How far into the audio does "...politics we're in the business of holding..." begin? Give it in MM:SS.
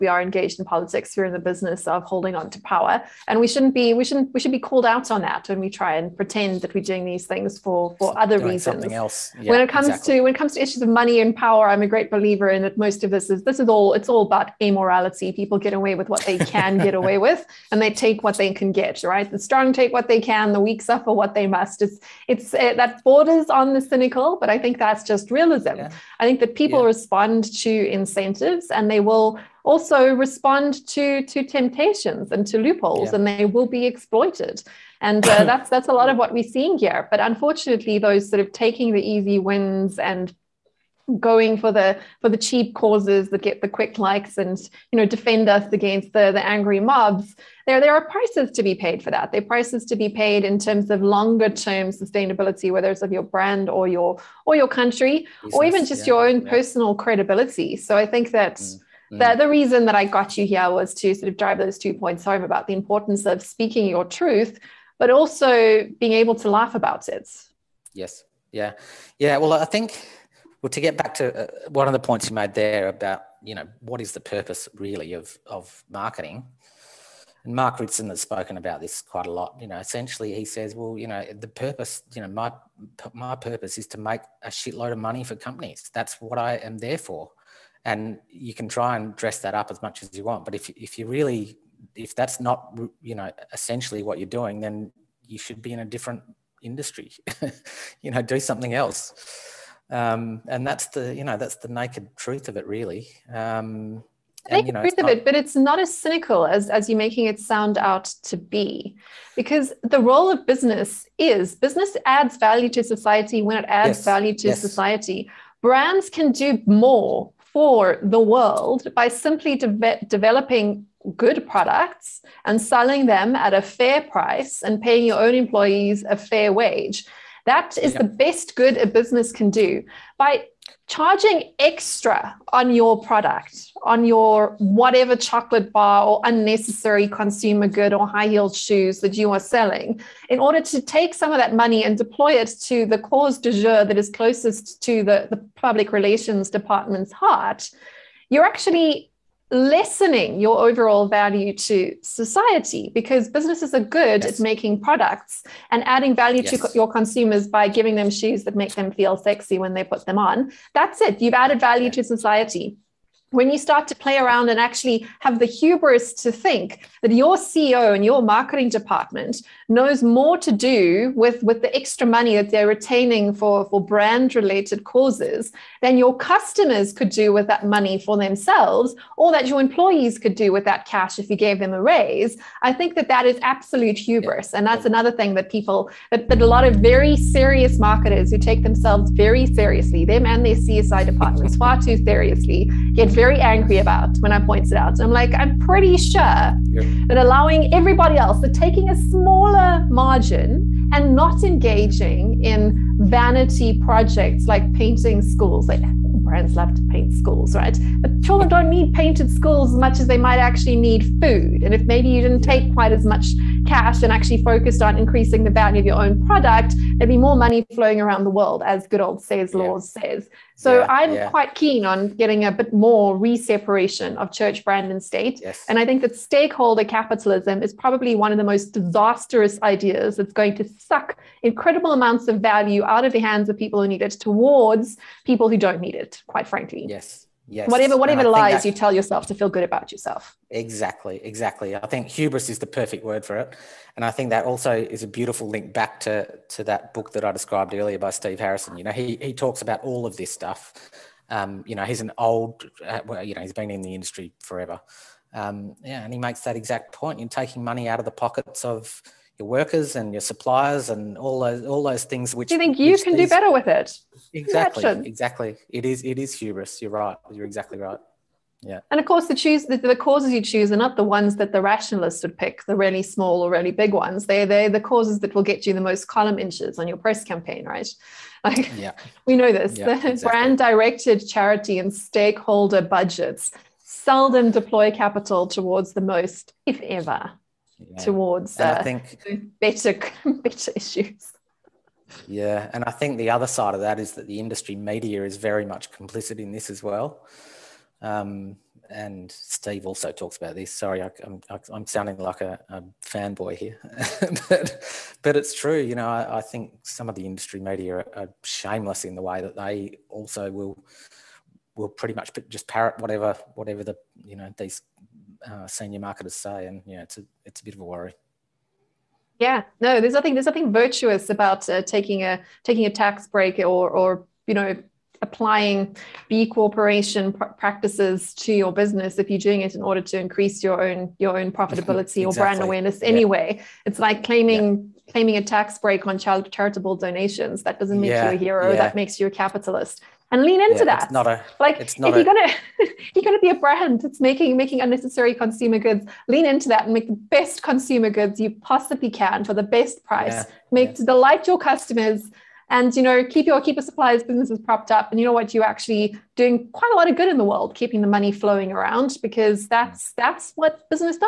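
00:00.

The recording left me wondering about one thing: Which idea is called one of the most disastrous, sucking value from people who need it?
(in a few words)
stakeholder capitalism.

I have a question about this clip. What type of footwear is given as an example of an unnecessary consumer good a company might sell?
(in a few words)
high heeled shoes.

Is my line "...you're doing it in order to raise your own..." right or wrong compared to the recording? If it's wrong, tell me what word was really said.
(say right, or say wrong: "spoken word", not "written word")
wrong: "increase", not "raise".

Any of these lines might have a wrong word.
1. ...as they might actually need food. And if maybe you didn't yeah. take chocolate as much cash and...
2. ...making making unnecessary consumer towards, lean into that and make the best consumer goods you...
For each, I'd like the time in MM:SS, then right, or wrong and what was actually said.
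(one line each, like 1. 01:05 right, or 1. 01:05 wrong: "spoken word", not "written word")
1. 03:29 wrong: "quite", not "chocolate"
2. 05:44 wrong: "goods", not "towards".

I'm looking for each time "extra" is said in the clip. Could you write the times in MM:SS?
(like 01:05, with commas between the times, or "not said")
02:11, 02:51.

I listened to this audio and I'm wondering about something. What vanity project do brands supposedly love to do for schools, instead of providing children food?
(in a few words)
painting schools.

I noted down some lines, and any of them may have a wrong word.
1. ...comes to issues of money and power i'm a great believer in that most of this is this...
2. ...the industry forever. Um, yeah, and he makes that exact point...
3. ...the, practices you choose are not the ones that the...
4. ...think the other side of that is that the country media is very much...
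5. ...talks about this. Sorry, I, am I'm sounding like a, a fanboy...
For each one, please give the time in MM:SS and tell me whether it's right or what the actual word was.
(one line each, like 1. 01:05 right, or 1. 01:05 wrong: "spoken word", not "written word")
1. 00:10 right
2. 04:13 right
3. 04:29 wrong: "causes", not "practices"
4. 04:52 wrong: "industry", not "country"
5. 05:00 right.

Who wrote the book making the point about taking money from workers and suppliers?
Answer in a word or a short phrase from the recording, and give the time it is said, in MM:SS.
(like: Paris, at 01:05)
Steve Harrison, at 04:08.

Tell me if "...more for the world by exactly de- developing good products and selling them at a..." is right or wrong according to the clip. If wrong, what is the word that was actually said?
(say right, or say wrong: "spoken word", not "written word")
wrong: "simply", not "exactly".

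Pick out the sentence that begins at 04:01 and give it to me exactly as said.
I think hubris is the perfect word for it.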